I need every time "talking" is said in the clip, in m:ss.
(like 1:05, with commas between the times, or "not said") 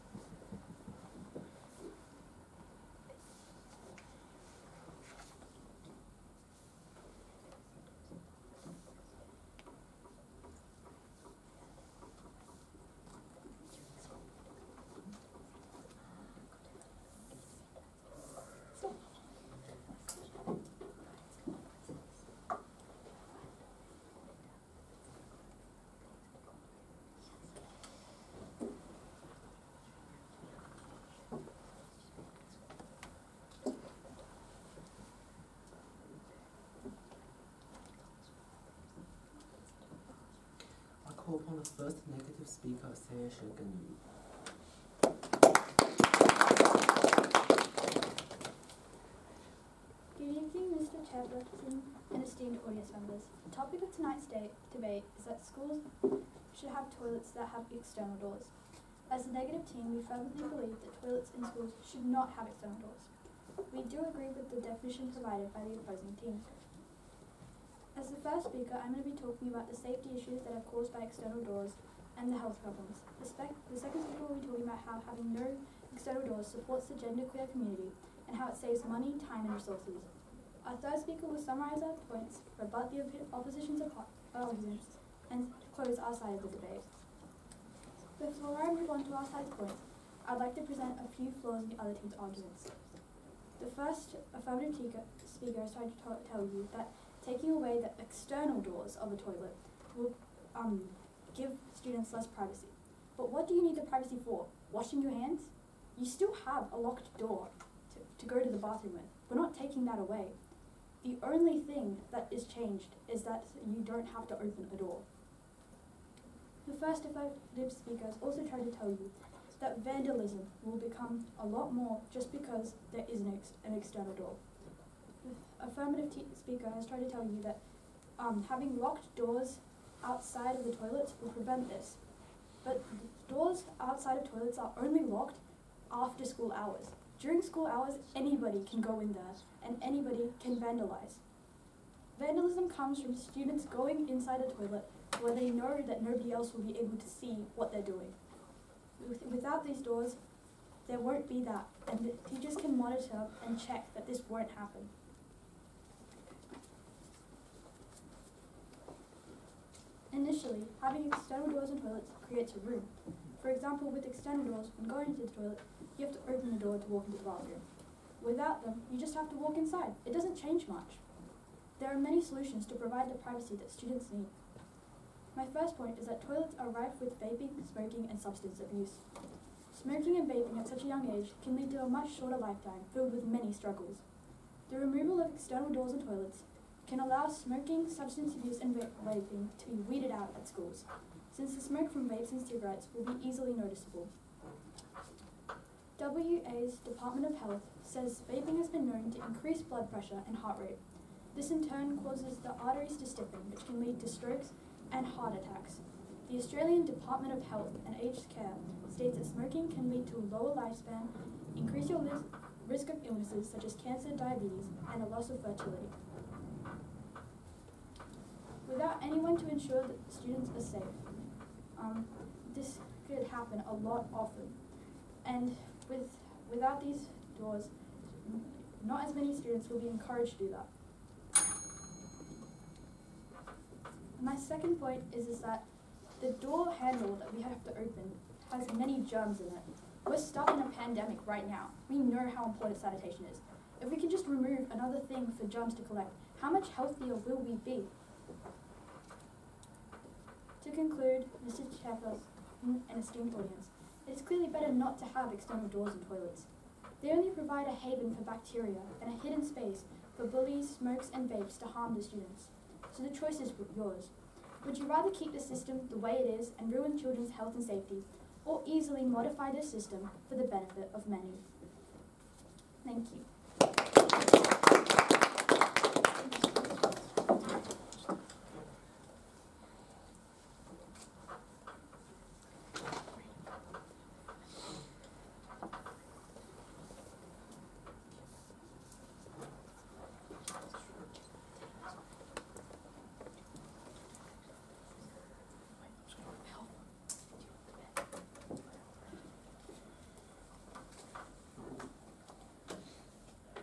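1:09, 1:14.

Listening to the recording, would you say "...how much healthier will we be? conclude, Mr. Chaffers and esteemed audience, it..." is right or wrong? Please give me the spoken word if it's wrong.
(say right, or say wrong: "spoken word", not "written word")
right.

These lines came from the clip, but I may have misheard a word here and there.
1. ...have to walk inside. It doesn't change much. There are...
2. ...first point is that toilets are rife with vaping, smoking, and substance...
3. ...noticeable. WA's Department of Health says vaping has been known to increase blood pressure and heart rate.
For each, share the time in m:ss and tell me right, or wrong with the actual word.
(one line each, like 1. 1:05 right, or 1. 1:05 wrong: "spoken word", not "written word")
1. 2:49 right
2. 2:55 right
3. 3:13 right.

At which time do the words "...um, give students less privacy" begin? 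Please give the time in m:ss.
1:40.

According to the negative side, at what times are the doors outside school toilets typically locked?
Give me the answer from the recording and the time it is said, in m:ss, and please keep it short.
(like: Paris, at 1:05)
After school hours, at 2:15.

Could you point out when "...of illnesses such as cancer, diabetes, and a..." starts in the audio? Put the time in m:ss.
3:32.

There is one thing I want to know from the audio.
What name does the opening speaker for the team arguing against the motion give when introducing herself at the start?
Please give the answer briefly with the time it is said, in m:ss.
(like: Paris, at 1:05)
Saya Shoganu, at 0:42.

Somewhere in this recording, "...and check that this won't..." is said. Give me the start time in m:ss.
2:33.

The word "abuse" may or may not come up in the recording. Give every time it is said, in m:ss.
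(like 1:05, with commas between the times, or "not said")
2:58, 3:08.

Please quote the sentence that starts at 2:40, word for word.
Initially, having external doors and toilets creates a room.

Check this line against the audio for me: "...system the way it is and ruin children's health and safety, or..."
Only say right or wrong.
right.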